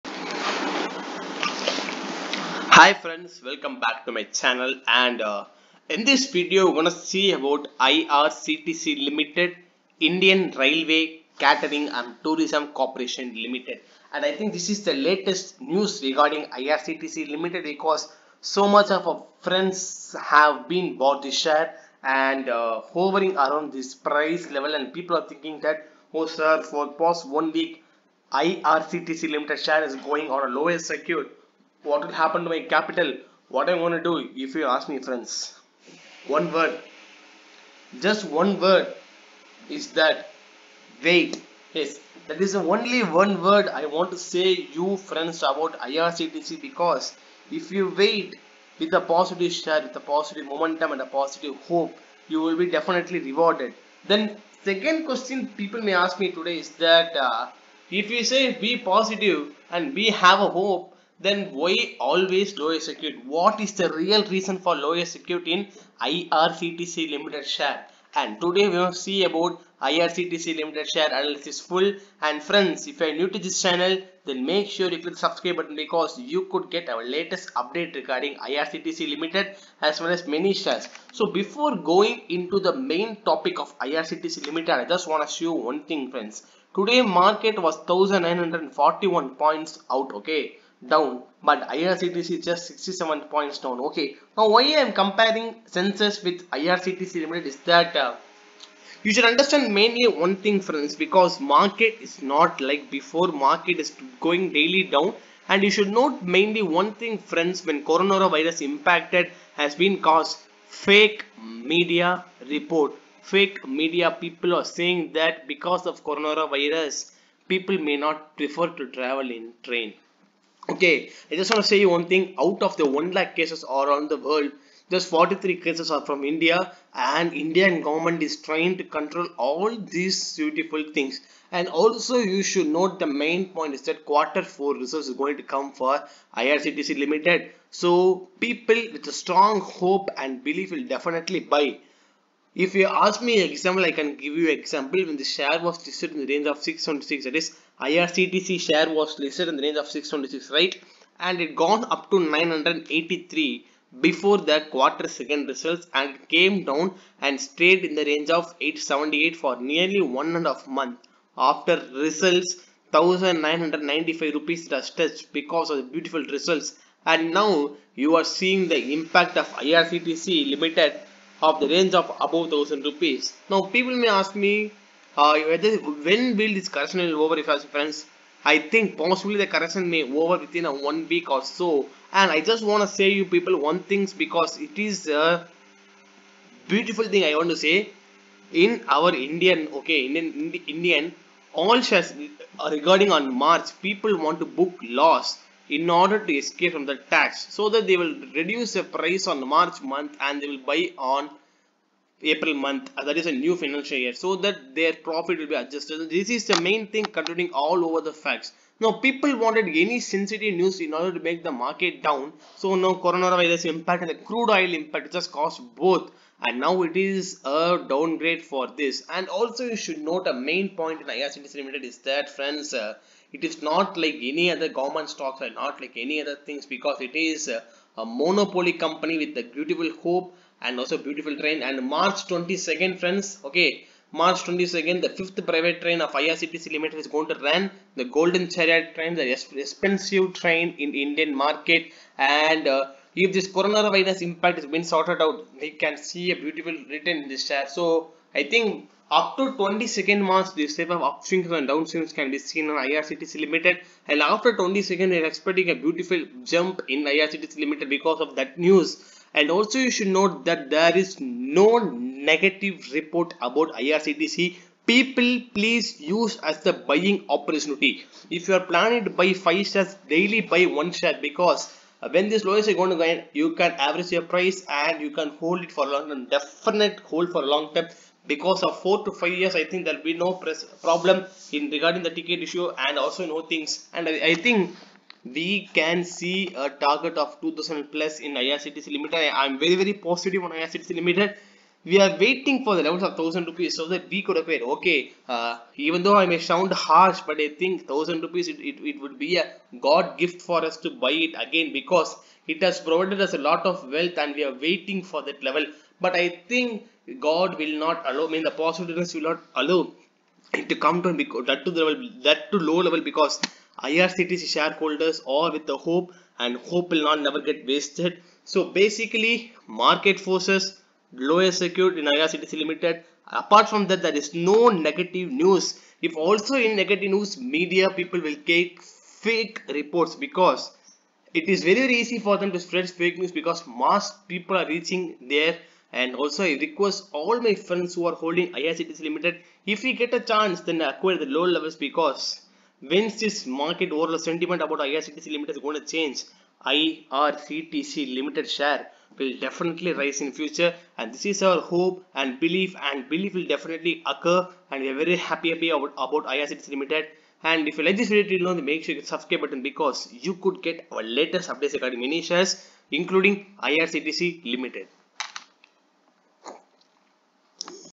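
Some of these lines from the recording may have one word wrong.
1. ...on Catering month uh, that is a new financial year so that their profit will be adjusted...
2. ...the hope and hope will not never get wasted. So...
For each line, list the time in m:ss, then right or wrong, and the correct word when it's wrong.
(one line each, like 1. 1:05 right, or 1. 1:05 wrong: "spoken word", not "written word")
1. 3:20 wrong: "April", not "Catering"
2. 5:15 right.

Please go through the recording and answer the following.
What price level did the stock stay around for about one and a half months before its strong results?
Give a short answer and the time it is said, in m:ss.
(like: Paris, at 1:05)
878, at 2:38.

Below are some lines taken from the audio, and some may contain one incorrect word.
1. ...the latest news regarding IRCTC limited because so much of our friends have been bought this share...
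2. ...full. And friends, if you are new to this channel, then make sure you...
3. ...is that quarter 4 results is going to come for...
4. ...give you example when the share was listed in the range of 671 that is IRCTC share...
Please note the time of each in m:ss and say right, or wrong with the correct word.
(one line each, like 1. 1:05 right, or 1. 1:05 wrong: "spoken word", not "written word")
1. 0:14 right
2. 1:11 right
3. 2:13 right
4. 2:24 wrong: "676", not "671".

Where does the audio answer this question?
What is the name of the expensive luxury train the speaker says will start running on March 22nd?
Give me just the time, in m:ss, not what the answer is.
3:58.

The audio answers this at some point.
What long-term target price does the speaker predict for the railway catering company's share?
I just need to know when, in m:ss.
4:47.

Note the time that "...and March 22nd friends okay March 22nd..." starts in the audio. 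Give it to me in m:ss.
3:51.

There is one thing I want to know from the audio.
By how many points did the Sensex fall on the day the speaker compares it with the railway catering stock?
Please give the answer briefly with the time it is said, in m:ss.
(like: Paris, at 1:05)
1941, at 1:27.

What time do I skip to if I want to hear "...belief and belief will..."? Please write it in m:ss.
5:52.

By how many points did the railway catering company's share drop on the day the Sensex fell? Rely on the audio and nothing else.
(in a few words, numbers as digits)
67.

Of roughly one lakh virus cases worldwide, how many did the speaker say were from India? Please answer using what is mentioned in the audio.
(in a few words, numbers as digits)
43.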